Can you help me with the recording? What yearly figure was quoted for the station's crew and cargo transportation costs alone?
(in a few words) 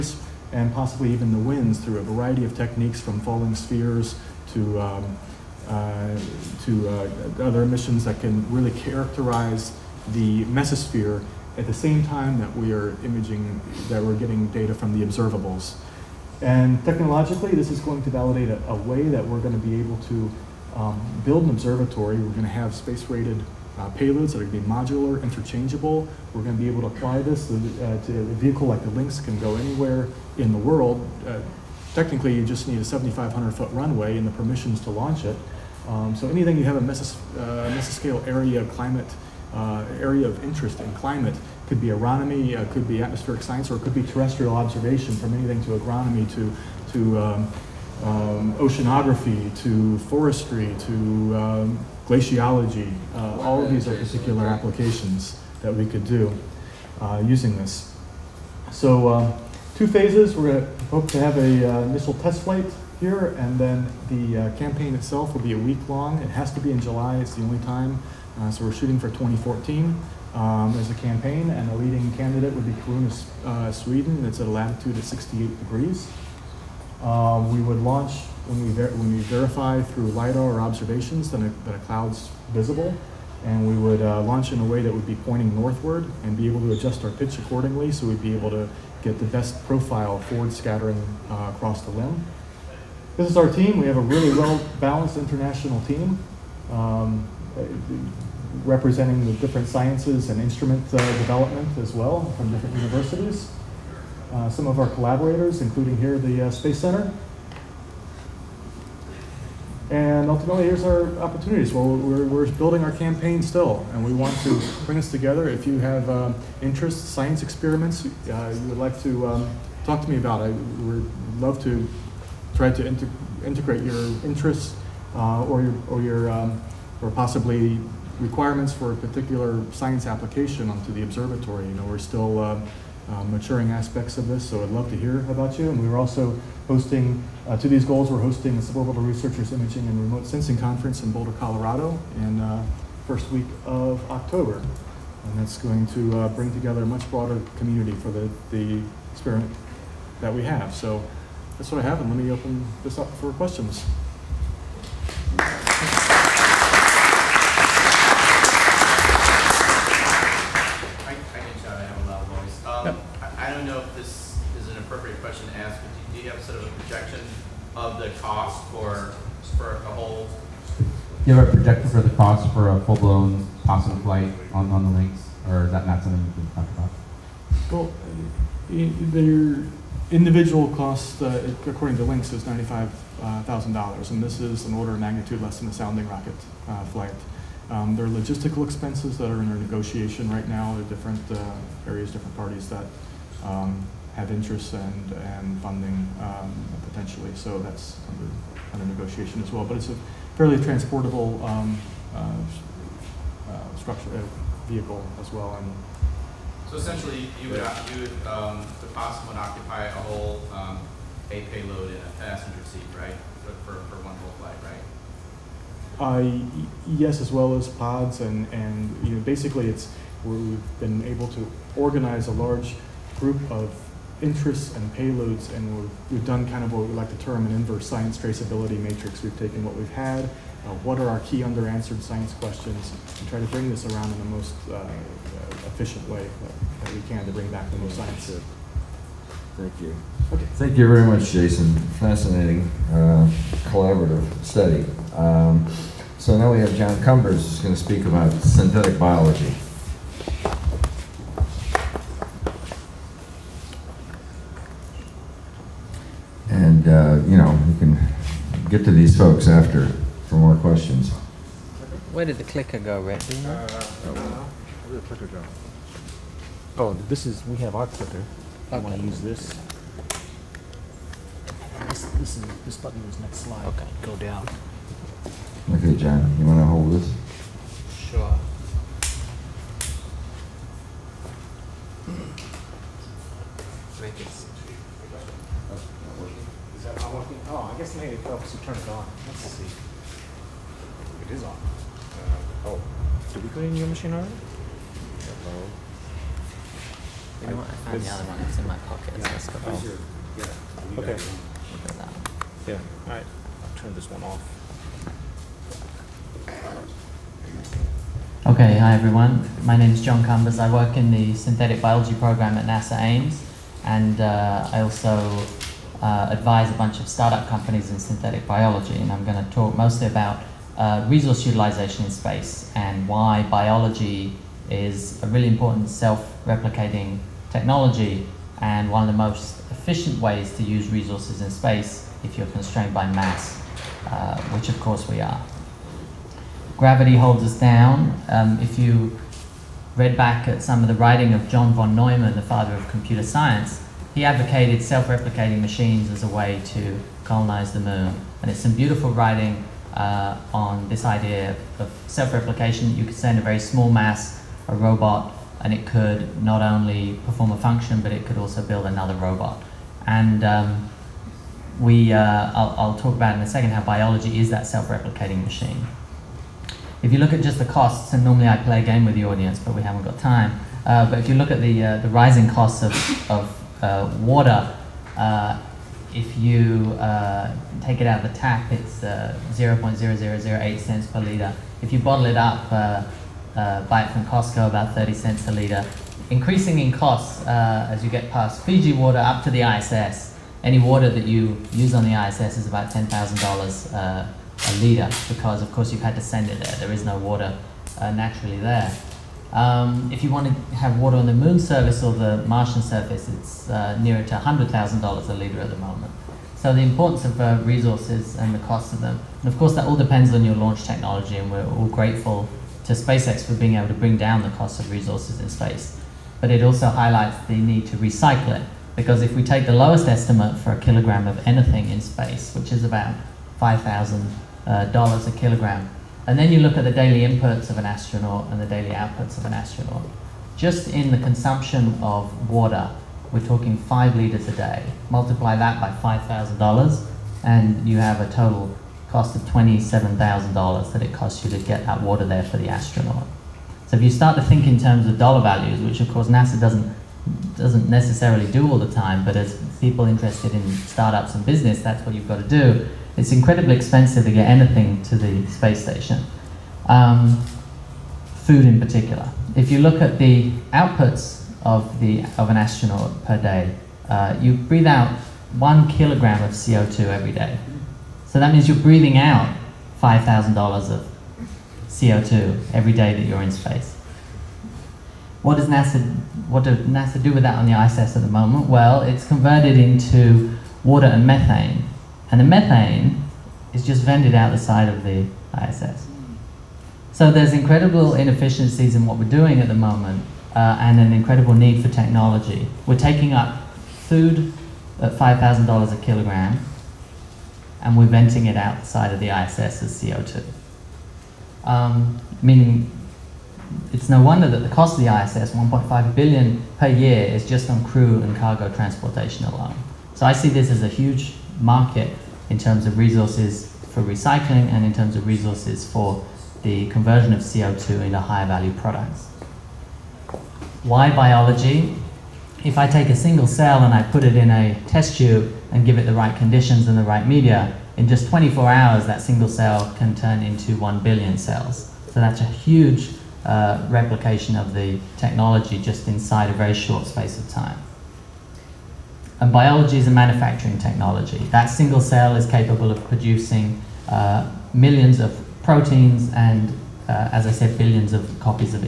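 1.5 billion.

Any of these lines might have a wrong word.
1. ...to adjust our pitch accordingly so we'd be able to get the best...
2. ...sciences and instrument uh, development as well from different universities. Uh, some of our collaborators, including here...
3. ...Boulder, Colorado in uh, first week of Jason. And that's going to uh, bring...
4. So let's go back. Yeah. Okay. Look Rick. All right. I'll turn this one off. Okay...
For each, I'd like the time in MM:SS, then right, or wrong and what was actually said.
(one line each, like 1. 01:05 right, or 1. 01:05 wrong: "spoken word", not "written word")
1. 01:26 right
2. 01:39 right
3. 02:21 wrong: "October", not "Jason"
4. 04:59 wrong: "Yeah", not "Rick".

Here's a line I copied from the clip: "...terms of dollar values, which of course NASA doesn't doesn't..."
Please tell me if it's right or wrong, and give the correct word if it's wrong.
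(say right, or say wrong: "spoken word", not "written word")
right.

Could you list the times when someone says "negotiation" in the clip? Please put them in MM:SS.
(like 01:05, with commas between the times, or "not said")
03:09, 03:18.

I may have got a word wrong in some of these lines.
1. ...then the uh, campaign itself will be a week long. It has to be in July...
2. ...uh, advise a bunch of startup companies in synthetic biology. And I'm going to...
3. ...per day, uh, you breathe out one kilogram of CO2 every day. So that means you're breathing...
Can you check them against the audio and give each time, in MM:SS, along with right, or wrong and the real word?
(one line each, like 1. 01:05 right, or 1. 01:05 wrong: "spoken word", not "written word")
1. 01:03 right
2. 05:16 right
3. 07:43 right.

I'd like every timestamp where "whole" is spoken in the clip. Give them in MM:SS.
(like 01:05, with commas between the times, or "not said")
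02:49, 03:29, 03:34.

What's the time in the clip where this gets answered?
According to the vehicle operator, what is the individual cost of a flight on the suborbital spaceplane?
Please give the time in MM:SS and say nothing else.
03:02.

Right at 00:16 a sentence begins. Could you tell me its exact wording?
And technologically, this is going to validate a, a way that we're going to be able to um, build an observatory.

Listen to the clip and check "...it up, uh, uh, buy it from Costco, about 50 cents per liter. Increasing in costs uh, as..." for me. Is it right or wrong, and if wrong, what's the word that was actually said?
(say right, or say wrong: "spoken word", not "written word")
wrong: "30", not "50".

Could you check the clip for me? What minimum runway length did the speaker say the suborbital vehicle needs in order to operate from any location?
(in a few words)
7,500 feet.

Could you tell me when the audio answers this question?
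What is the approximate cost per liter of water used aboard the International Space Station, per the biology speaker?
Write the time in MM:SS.
06:32.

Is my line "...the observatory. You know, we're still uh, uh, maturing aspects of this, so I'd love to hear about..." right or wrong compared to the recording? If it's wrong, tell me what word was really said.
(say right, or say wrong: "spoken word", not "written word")
right.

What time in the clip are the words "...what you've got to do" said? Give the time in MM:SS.
07:32.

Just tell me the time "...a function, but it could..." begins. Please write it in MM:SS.
05:57.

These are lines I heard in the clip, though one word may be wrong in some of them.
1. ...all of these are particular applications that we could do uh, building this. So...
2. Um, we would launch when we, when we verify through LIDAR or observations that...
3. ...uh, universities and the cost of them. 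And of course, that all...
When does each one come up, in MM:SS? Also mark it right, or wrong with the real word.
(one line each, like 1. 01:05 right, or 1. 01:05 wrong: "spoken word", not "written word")
1. 00:53 wrong: "using", not "building"
2. 01:17 right
3. 06:47 wrong: "resources", not "universities".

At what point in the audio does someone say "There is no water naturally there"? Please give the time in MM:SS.
06:36.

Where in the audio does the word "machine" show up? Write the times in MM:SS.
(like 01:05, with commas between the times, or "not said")
04:54, 05:45, 06:05.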